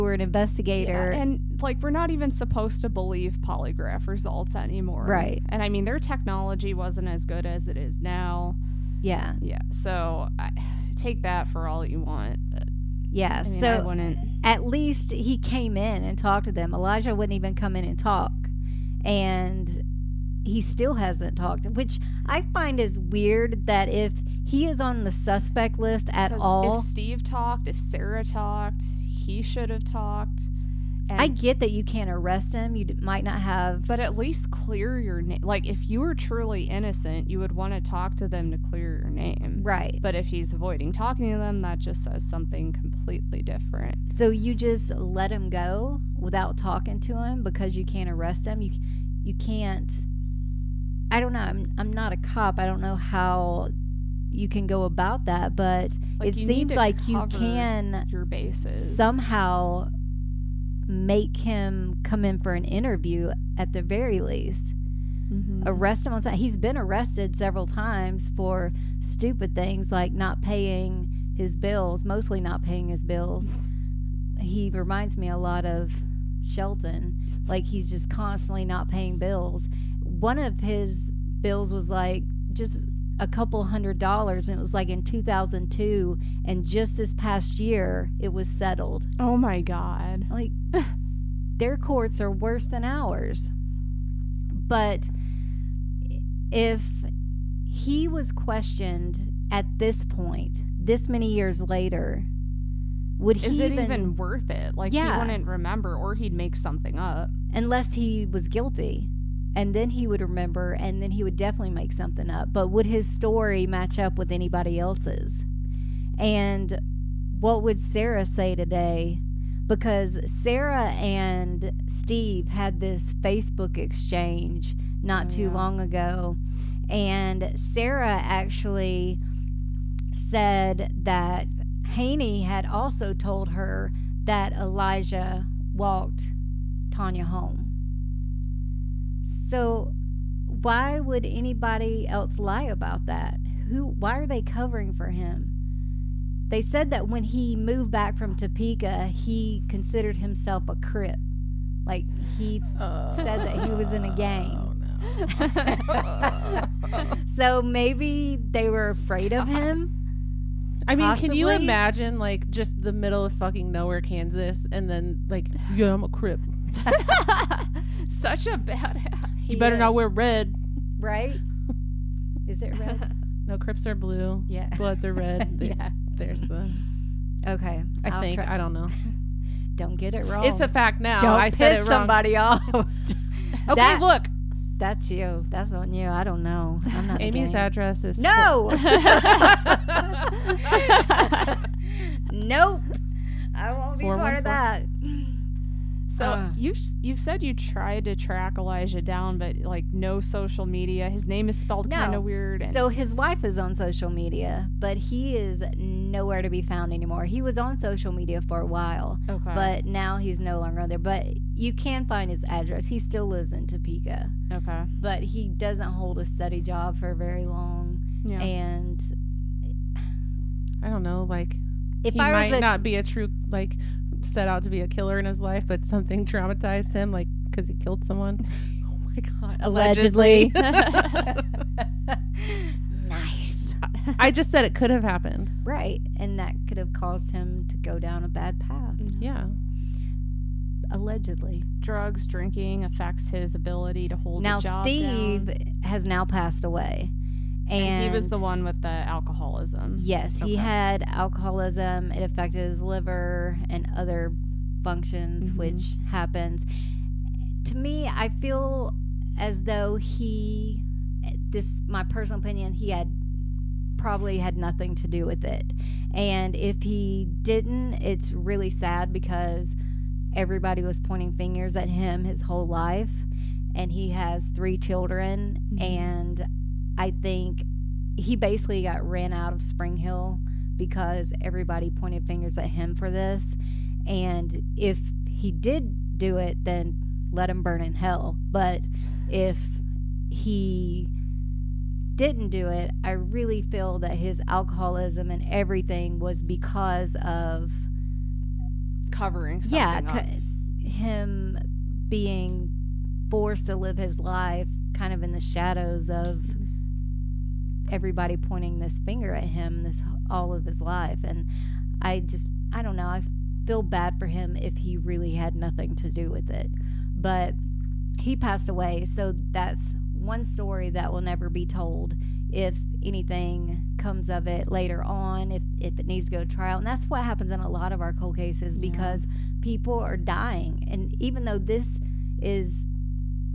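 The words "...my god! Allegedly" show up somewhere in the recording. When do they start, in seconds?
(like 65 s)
229 s.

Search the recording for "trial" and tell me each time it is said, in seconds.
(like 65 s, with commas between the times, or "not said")
326 s.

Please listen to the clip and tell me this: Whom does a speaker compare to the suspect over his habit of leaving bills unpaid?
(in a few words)
Shelton.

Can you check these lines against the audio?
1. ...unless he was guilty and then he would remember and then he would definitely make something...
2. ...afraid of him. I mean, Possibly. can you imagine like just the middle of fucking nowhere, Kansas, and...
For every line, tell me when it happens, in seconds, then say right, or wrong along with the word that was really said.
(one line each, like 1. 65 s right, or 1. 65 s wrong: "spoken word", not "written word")
1. 107 s right
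2. 158 s right.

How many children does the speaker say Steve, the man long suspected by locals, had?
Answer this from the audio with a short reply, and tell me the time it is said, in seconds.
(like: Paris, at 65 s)
3, at 274 s.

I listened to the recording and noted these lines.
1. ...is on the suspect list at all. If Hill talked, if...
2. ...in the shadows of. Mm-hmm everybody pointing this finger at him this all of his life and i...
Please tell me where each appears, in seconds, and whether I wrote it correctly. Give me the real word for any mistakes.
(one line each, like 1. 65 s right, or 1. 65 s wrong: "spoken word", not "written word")
1. 24 s wrong: "Steve", not "Hill"
2. 305 s right.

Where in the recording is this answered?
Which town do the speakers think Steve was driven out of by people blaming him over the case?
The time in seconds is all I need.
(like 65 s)
279 s.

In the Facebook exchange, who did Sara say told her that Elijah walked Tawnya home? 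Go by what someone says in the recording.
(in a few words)
Haney.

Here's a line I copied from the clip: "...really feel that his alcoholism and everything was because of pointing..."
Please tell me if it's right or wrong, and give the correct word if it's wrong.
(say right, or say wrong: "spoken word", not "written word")
wrong: "covering", not "pointing".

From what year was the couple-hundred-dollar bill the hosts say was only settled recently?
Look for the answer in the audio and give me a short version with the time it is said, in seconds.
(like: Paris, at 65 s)
2002, at 85 s.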